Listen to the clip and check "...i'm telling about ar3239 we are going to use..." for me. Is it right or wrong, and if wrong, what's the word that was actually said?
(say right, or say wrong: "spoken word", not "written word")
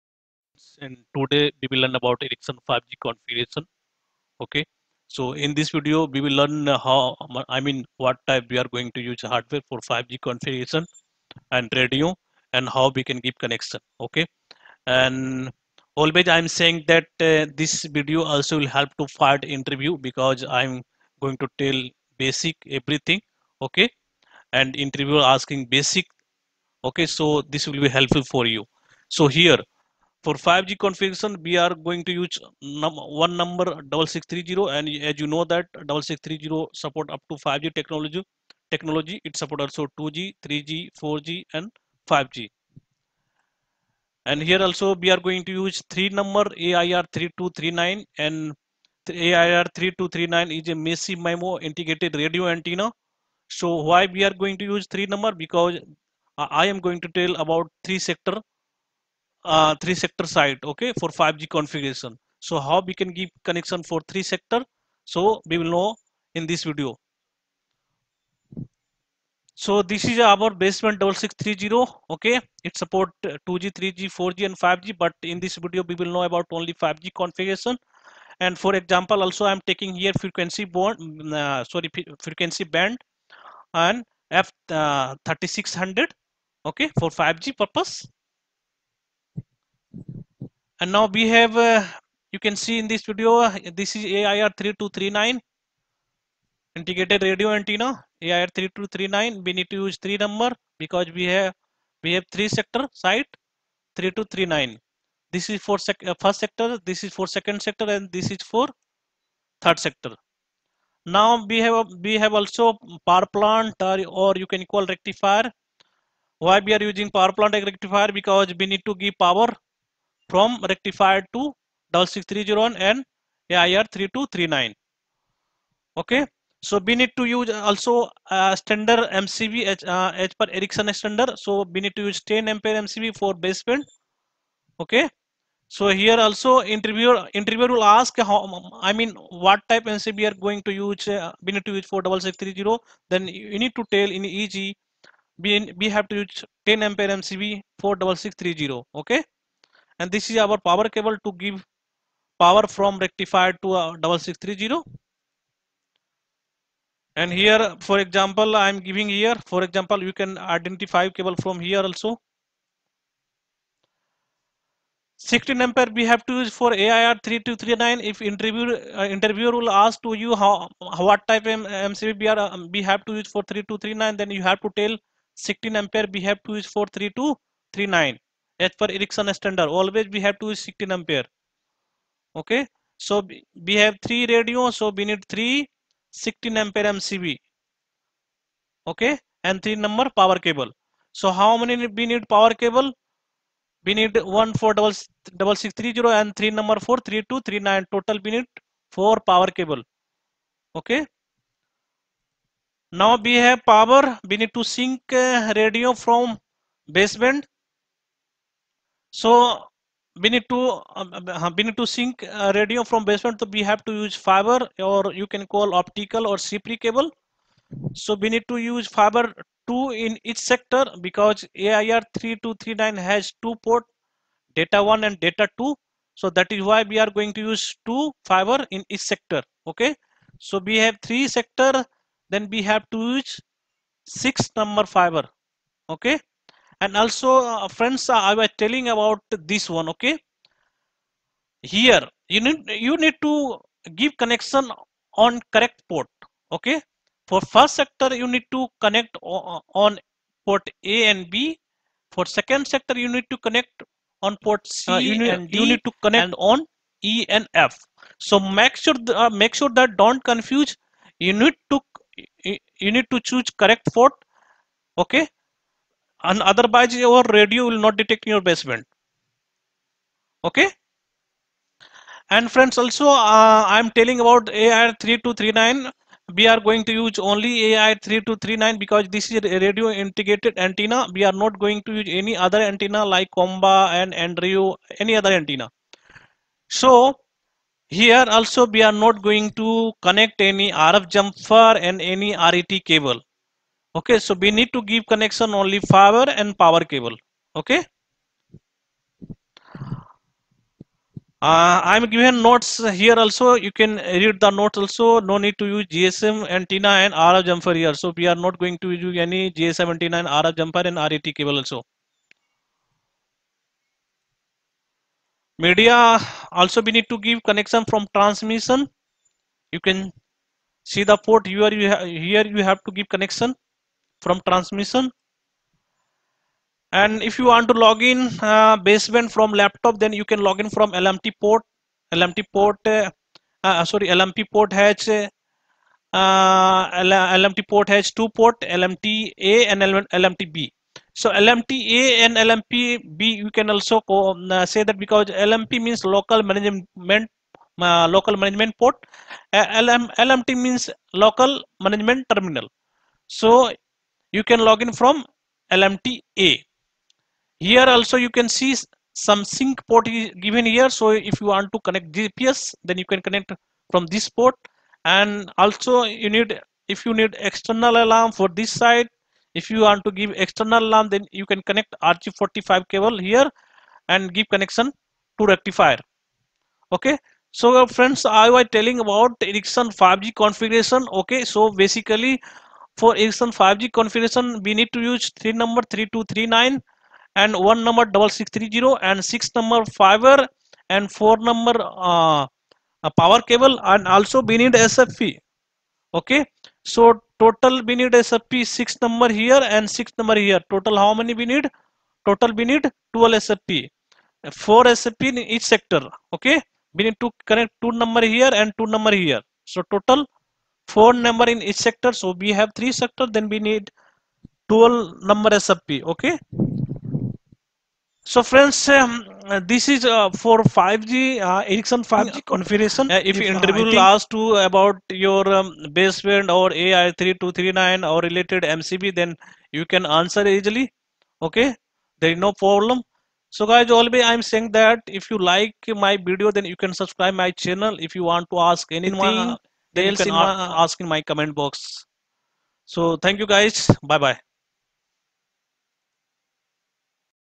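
right.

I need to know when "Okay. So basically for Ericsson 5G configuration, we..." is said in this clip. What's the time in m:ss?
6:21.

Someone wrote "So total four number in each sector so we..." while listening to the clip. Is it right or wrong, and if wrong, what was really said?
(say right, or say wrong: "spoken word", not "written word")
right.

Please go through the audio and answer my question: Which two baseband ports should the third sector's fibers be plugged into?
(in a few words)
E and F.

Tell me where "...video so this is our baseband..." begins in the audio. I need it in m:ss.
1:06.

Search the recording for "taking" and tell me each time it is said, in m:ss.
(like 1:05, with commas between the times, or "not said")
1:19.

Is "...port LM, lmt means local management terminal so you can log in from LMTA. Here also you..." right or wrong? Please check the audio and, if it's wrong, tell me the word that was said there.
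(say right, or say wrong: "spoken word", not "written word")
right.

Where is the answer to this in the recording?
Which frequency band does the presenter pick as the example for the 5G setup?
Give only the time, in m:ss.
1:25.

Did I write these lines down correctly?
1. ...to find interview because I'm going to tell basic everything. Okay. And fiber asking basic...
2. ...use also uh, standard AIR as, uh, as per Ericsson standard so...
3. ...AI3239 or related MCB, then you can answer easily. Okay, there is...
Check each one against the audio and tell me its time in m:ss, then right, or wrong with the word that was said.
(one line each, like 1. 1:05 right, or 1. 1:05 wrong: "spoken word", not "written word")
1. 0:18 wrong: "interviewer", not "fiber"
2. 2:07 wrong: "MCB", not "AIR"
3. 7:06 right.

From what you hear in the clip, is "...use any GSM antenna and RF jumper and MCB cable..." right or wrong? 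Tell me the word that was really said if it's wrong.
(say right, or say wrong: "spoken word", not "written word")
wrong: "RET", not "MCB".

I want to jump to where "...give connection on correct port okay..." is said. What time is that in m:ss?
4:04.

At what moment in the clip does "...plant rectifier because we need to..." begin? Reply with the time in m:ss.
1:57.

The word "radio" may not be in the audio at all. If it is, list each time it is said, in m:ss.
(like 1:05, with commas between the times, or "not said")
0:11, 0:52, 1:37, 3:04, 3:25, 3:32, 4:27, 4:39.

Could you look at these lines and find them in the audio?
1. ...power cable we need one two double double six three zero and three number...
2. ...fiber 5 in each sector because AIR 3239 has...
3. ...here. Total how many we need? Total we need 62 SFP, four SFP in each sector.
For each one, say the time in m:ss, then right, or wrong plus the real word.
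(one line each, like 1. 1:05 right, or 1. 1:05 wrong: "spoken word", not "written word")
1. 3:12 wrong: "four", not "two"
2. 3:38 wrong: "2", not "5"
3. 6:40 wrong: "12", not "62".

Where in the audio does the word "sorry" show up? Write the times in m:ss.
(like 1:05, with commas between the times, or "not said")
1:21, 5:33.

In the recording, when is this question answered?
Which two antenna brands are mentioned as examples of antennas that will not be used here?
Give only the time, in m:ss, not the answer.
4:43.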